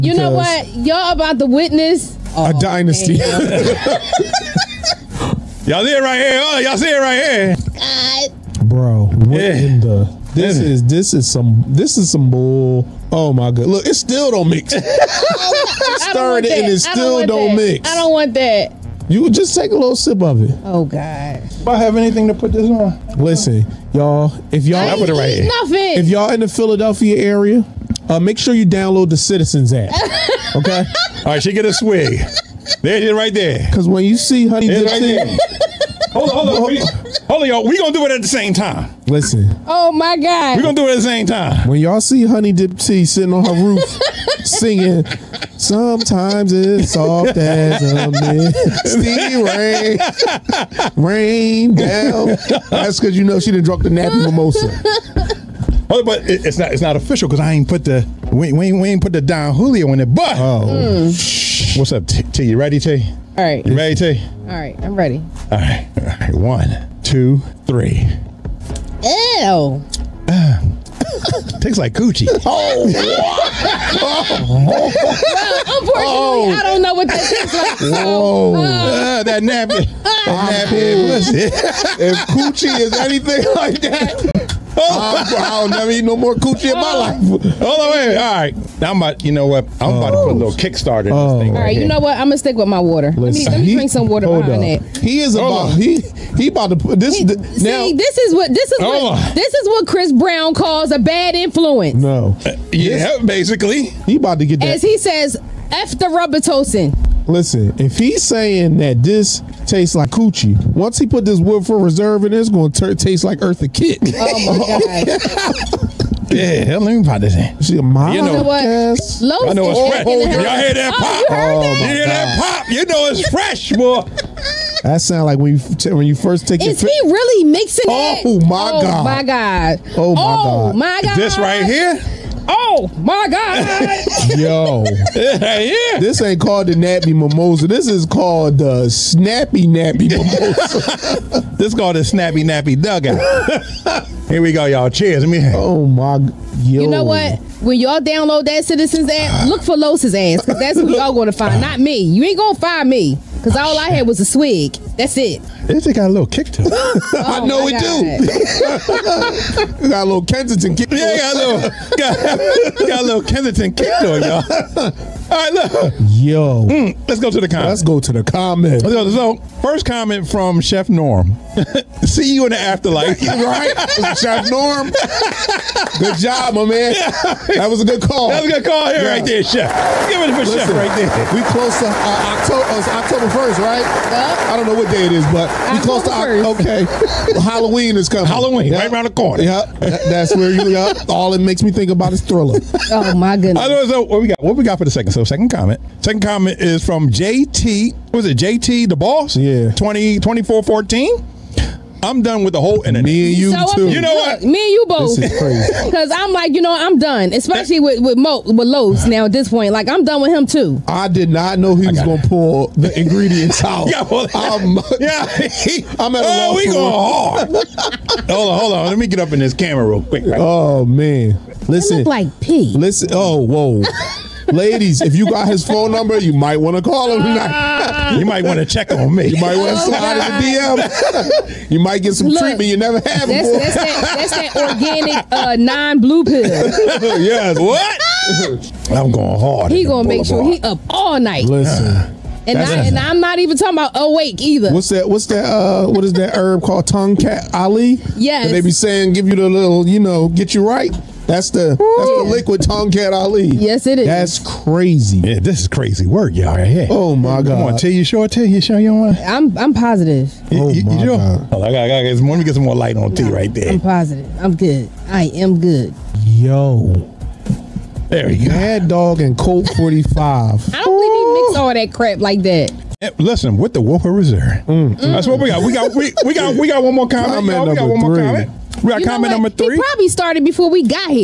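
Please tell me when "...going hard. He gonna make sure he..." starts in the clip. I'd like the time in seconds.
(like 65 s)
239 s.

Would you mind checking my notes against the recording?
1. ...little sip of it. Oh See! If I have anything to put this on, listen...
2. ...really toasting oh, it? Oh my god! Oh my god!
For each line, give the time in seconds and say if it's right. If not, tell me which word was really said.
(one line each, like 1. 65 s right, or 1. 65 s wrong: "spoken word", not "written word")
1. 19 s wrong: "God", not "See"
2. 127 s wrong: "mixing", not "toasting".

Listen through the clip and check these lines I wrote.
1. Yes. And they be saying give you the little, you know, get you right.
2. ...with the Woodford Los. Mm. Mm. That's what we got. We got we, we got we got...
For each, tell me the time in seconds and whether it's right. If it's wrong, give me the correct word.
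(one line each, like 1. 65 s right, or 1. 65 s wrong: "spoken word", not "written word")
1. 248 s right
2. 273 s wrong: "Reserve", not "Los".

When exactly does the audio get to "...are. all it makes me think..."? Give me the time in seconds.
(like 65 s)
190 s.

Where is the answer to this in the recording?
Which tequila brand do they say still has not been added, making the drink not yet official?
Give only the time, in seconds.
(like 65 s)
59 s.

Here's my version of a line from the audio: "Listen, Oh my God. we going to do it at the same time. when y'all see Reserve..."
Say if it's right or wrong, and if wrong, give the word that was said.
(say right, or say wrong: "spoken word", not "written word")
wrong: "Honey", not "Reserve".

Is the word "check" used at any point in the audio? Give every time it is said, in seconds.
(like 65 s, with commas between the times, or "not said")
228 s.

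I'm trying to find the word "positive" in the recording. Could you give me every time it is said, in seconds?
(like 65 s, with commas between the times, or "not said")
259 s, 263 s.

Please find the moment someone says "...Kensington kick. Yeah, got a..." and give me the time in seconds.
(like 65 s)
160 s.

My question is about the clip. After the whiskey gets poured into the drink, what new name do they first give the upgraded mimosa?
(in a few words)
snappy nappy mimosa.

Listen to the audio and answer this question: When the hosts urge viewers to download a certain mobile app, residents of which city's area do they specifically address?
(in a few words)
Philadelphia.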